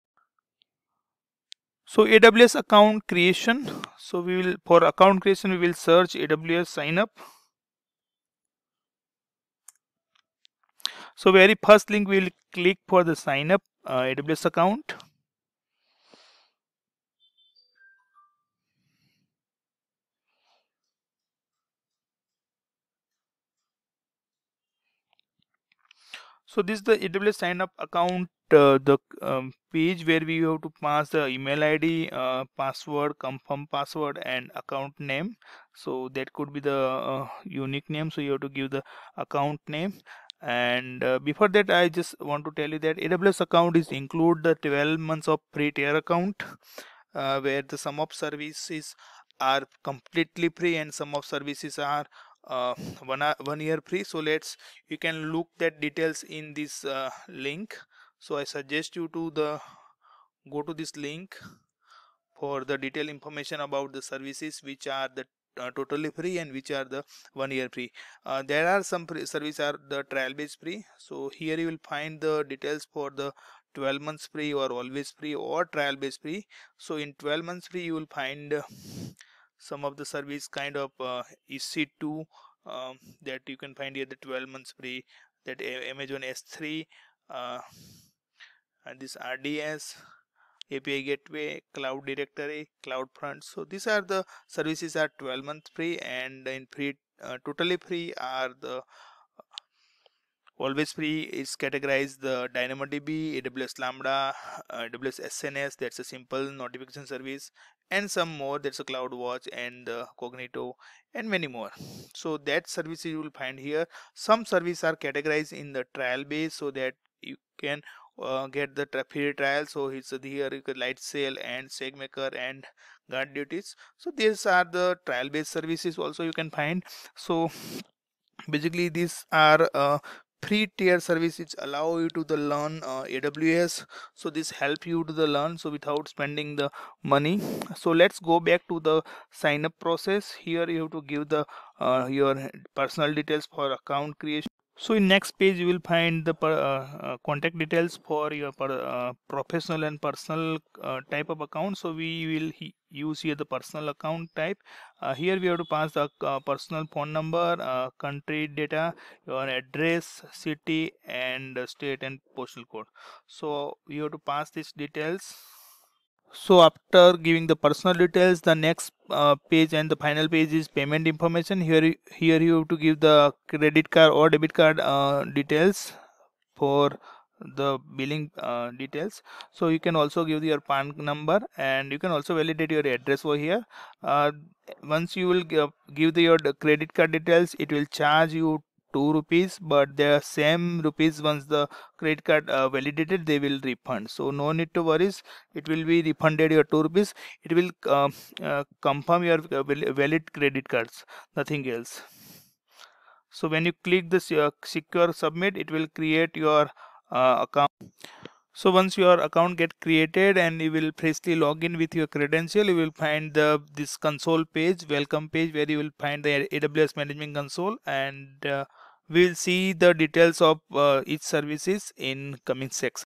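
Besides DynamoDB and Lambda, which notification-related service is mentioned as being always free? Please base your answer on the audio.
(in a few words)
AWS SNS.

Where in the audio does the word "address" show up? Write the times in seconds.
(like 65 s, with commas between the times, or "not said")
159 s, 182 s.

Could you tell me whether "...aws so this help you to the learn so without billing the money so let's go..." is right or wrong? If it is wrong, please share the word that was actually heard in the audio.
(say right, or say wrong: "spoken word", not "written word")
wrong: "spending", not "billing".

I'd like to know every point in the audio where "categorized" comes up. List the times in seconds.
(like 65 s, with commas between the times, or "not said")
101 s, 114 s.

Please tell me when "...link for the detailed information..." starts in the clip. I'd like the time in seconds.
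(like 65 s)
61 s.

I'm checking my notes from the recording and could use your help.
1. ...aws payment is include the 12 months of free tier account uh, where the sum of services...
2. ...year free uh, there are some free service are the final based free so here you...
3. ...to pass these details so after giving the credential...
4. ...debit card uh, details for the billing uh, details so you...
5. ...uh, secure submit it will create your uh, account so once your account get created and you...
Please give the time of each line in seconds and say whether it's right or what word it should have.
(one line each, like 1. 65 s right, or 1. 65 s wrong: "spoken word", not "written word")
1. 42 s wrong: "account", not "payment"
2. 67 s wrong: "trial", not "final"
3. 164 s wrong: "personal", not "credential"
4. 174 s right
5. 204 s right.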